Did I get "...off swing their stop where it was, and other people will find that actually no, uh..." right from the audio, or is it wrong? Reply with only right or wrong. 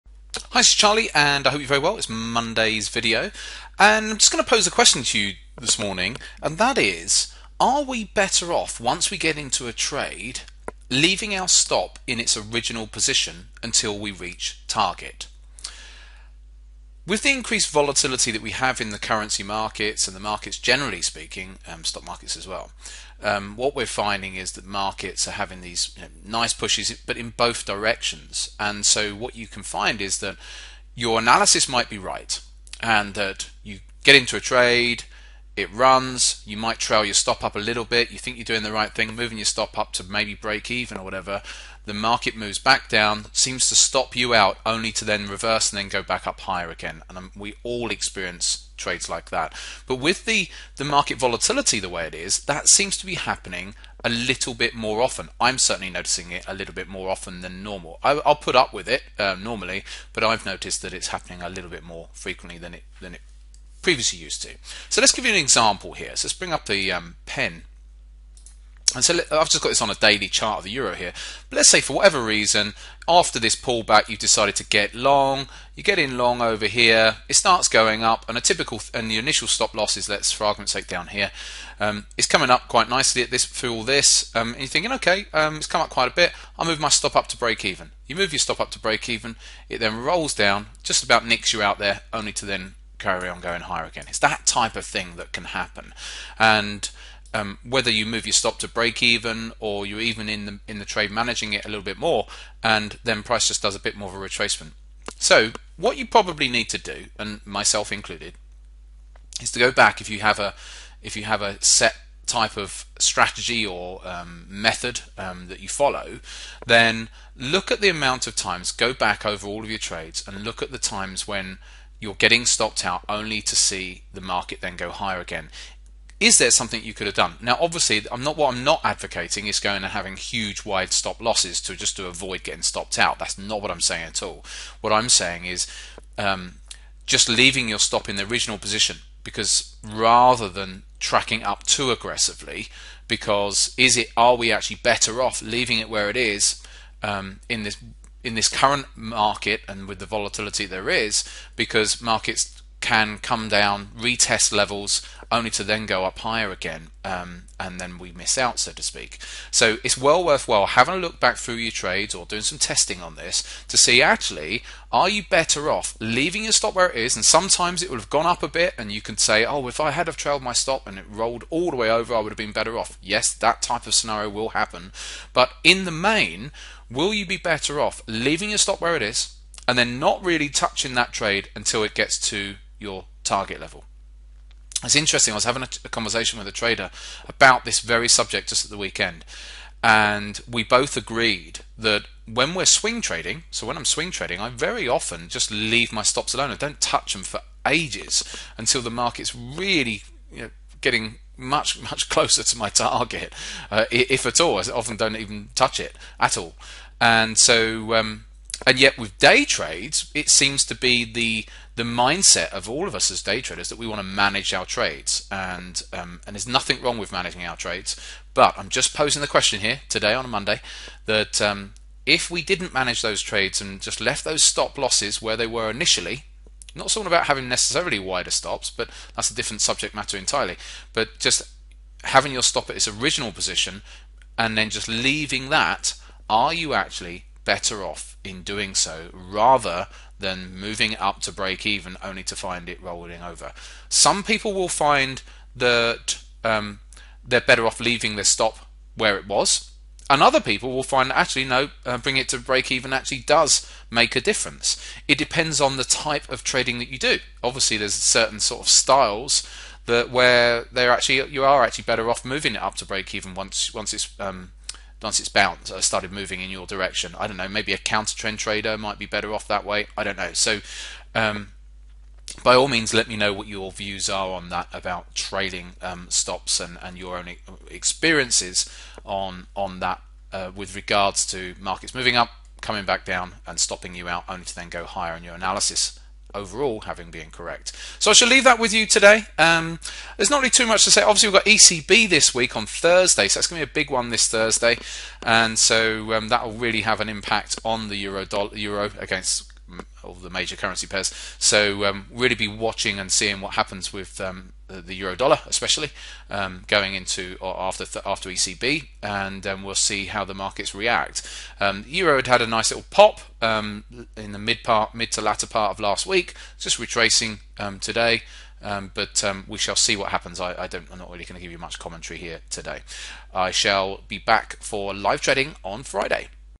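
wrong.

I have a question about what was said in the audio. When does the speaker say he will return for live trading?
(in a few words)
Friday.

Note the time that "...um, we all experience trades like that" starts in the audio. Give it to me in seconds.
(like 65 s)
47 s.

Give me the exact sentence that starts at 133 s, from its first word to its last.
That's not what I'm saying at all.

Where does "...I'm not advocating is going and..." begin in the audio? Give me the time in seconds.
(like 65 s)
128 s.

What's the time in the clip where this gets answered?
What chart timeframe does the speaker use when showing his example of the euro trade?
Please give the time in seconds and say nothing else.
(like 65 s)
69 s.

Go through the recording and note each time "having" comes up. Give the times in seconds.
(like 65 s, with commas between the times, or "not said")
25 s, 129 s, 160 s, 185 s, 227 s, 232 s, 286 s.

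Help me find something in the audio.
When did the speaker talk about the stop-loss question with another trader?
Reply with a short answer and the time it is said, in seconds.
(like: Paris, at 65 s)
At the weekend, at 188 s.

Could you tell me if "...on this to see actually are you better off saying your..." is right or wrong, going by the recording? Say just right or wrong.
wrong.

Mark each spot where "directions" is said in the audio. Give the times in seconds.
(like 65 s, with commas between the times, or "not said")
27 s, 266 s.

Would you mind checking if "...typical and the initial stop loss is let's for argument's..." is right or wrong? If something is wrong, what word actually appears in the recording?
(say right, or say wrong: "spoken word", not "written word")
right.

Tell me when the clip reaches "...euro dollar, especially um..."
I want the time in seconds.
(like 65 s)
304 s.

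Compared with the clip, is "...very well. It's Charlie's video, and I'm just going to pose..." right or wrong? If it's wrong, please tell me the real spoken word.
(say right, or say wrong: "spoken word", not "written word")
wrong: "Monday", not "Charlie".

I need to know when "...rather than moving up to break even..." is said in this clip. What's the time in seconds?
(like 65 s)
239 s.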